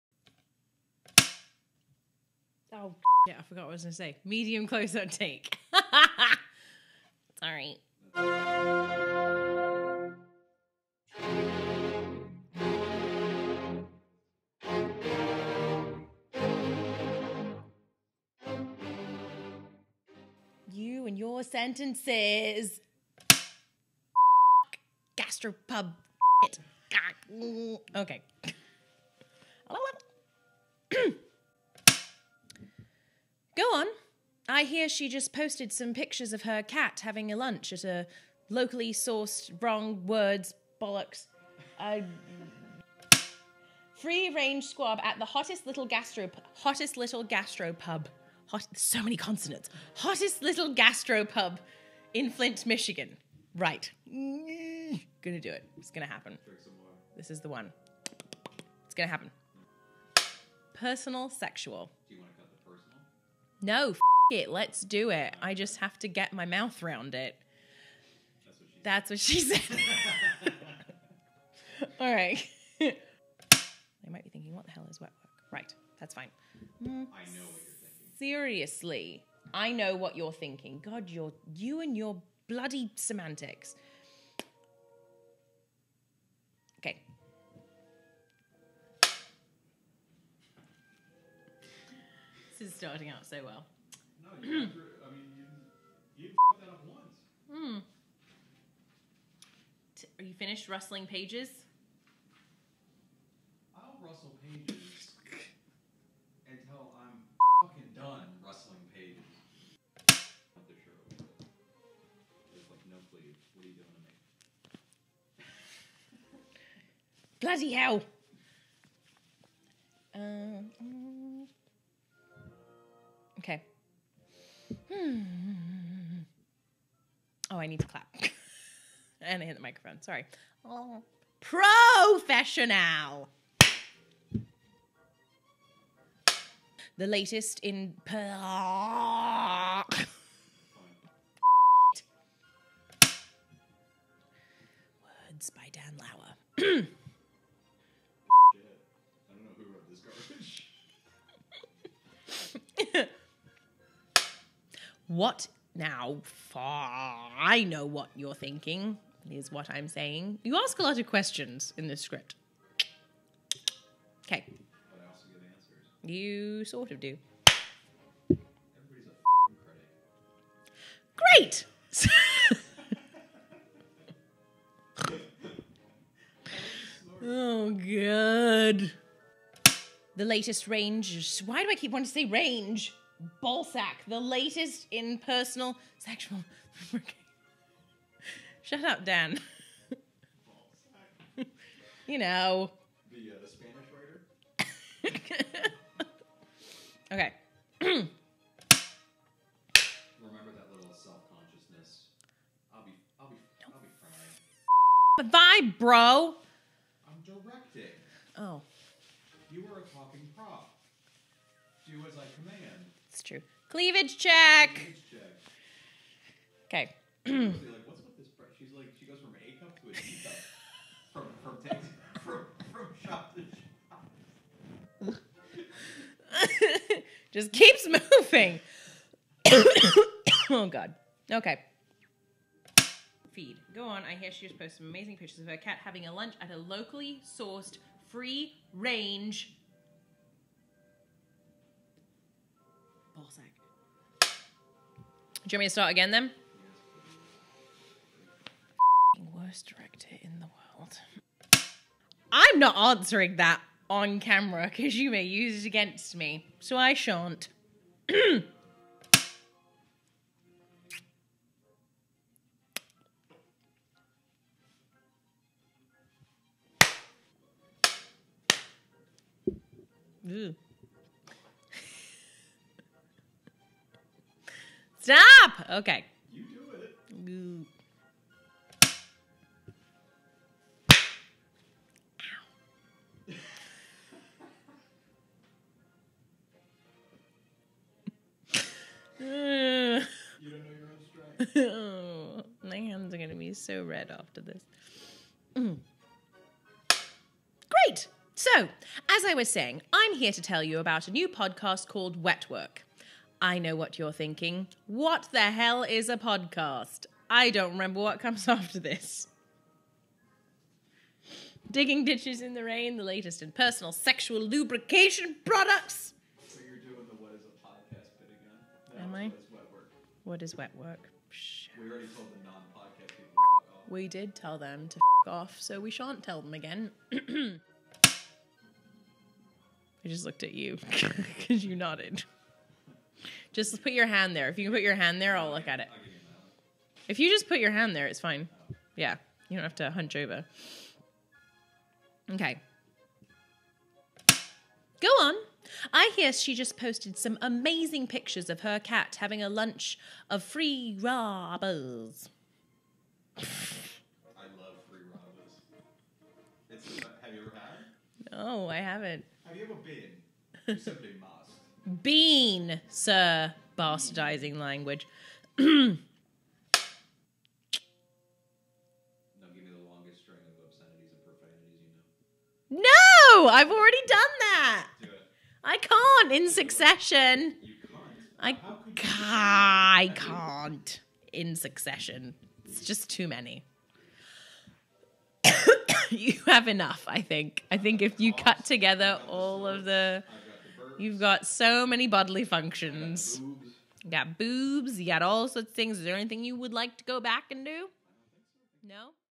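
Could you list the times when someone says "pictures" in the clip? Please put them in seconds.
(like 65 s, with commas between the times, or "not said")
35 s, 235 s, 348 s.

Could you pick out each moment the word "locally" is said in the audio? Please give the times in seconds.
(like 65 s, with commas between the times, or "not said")
38 s, 236 s.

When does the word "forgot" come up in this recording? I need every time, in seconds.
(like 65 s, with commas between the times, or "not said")
3 s.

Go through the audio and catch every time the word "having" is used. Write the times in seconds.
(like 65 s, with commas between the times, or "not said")
37 s, 235 s, 349 s.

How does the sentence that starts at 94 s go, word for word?
No, you, I mean, you, you that up once.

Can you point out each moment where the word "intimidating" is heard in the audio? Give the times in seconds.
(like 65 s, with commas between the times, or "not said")
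not said.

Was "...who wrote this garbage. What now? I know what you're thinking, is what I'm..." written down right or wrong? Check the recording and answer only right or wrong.
right.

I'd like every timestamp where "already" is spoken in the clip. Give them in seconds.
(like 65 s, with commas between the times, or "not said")
321 s, 373 s.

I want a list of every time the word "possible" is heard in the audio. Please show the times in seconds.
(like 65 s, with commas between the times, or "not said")
not said.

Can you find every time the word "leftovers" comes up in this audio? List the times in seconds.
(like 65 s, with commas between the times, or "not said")
not said.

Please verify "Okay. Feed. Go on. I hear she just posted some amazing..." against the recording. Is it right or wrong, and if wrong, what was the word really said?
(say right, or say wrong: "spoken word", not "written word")
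right.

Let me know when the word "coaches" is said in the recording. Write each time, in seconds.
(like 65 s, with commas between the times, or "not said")
not said.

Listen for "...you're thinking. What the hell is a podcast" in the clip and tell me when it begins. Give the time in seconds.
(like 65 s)
303 s.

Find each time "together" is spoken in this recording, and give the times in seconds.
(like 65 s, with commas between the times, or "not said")
388 s.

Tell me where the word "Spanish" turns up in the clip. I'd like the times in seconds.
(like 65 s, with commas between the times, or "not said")
193 s.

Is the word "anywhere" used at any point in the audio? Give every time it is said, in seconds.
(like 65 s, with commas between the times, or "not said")
not said.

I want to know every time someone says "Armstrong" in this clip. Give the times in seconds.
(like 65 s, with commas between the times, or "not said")
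not said.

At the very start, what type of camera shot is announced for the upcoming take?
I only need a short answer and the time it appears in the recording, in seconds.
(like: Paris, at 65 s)
Medium close up, at 4 s.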